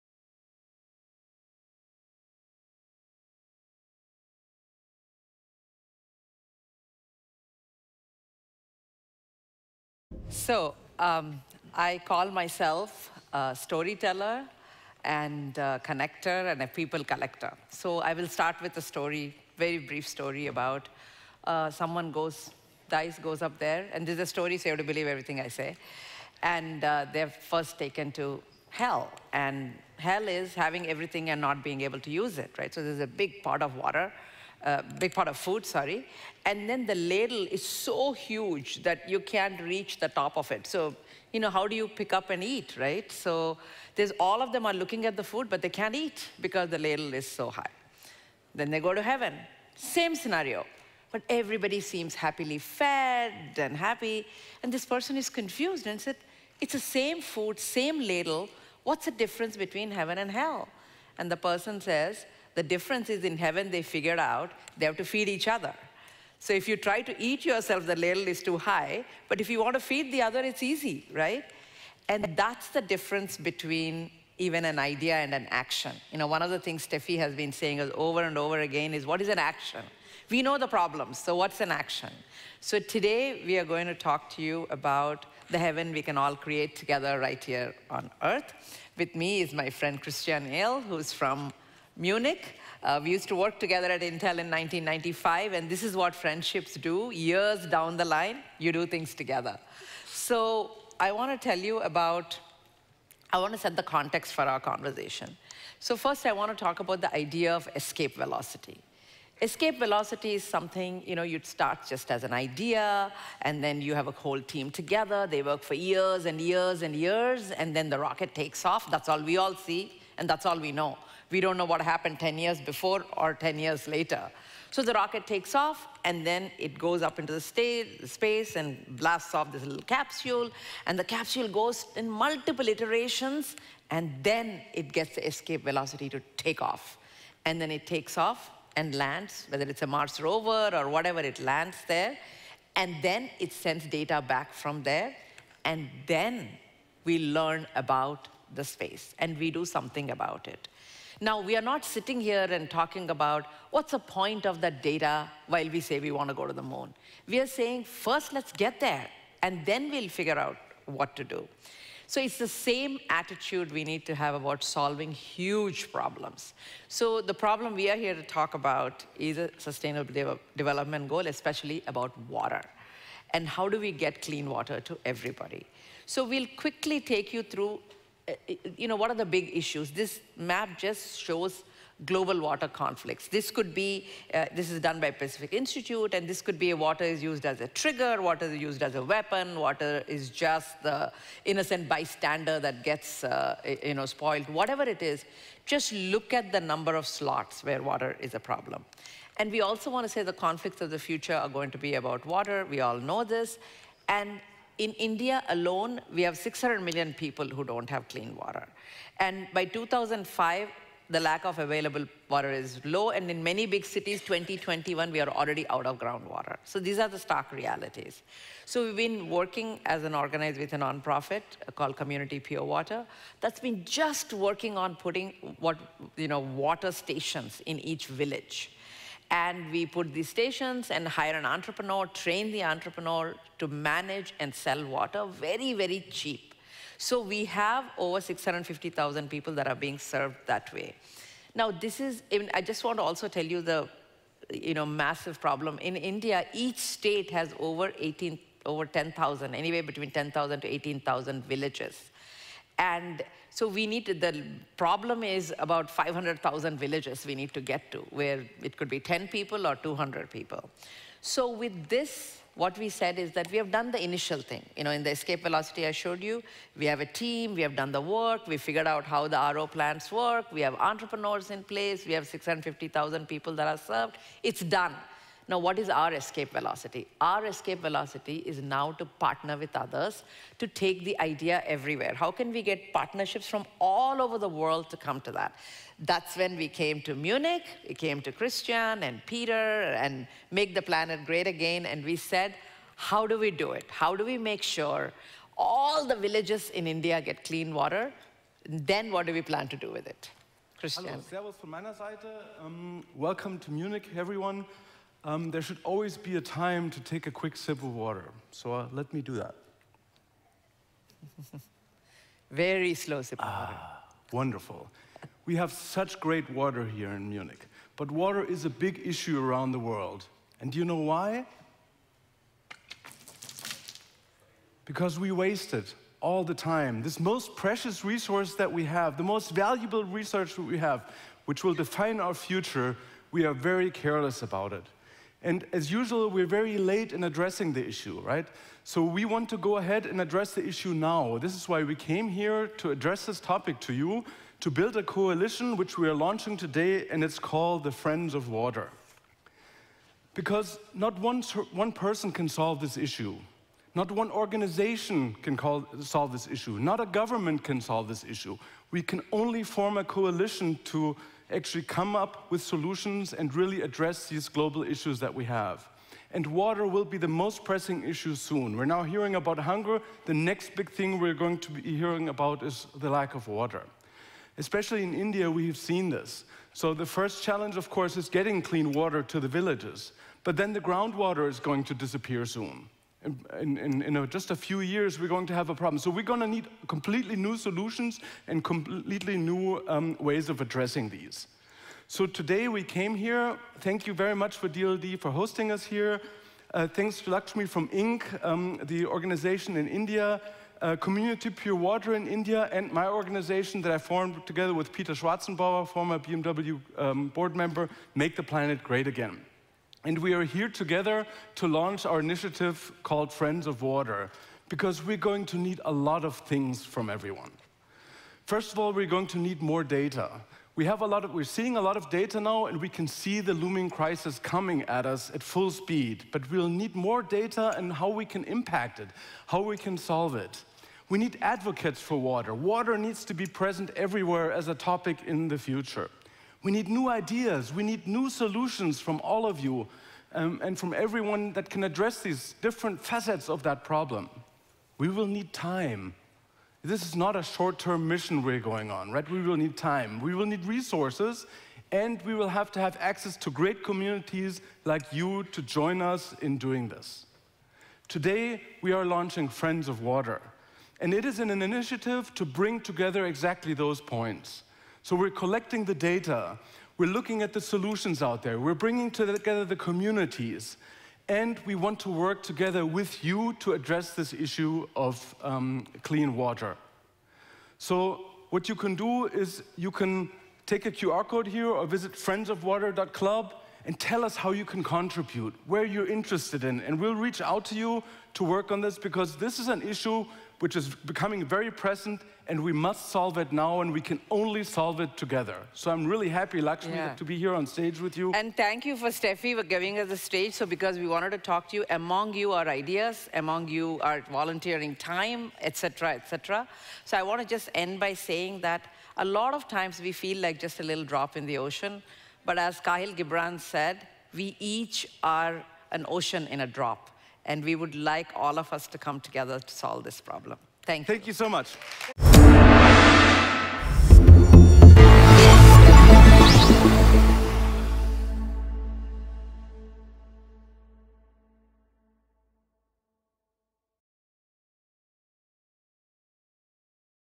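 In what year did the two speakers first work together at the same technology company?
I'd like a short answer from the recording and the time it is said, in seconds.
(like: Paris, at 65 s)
1995, at 94 s.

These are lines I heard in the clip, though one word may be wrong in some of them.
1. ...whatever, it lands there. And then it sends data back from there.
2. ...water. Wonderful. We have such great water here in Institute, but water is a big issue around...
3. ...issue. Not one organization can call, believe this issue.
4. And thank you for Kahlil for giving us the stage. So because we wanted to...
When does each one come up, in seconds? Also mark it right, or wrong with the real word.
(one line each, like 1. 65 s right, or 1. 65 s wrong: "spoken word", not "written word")
1. 140 s right
2. 313 s wrong: "Munich", not "Institute"
3. 352 s wrong: "solve", not "believe"
4. 498 s wrong: "Steffi", not "Kahlil".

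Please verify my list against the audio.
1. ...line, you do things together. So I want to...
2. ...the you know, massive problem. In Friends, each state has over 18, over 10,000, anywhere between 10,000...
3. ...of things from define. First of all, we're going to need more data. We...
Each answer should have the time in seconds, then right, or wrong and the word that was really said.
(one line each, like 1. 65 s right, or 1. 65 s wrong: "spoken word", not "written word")
1. 98 s right
2. 243 s wrong: "India", not "Friends"
3. 416 s wrong: "everyone", not "define".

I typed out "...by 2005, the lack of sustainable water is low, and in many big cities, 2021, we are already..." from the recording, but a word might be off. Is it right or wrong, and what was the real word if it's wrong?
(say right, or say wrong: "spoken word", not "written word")
wrong: "available", not "sustainable".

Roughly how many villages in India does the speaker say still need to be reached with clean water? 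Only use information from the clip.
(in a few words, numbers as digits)
500,000.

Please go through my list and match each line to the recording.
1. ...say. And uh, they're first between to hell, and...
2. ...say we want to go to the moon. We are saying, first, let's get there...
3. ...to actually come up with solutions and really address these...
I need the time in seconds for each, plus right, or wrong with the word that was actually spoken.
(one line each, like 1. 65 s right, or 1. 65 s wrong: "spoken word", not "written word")
1. 25 s wrong: "taken", not "between"
2. 155 s right
3. 360 s right.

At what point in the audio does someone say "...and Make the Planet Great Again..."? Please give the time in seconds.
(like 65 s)
290 s.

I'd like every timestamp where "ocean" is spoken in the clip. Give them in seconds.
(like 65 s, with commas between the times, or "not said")
511 s, 516 s.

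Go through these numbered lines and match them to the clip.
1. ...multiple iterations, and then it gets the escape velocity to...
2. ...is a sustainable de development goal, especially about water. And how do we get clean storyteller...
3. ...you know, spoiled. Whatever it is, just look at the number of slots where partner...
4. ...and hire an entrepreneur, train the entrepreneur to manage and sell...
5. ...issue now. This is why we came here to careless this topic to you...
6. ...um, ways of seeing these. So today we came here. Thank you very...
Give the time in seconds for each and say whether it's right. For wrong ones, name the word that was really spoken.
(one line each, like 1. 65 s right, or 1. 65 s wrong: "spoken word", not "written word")
1. 132 s right
2. 169 s wrong: "water", not "storyteller"
3. 193 s wrong: "water", not "partner"
4. 230 s right
5. 340 s wrong: "address", not "careless"
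6. 389 s wrong: "addressing", not "seeing".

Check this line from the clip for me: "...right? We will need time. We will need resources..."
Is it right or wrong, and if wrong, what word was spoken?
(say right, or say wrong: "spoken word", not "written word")
right.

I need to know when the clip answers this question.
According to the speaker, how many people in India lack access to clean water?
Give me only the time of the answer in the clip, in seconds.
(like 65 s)
206 s.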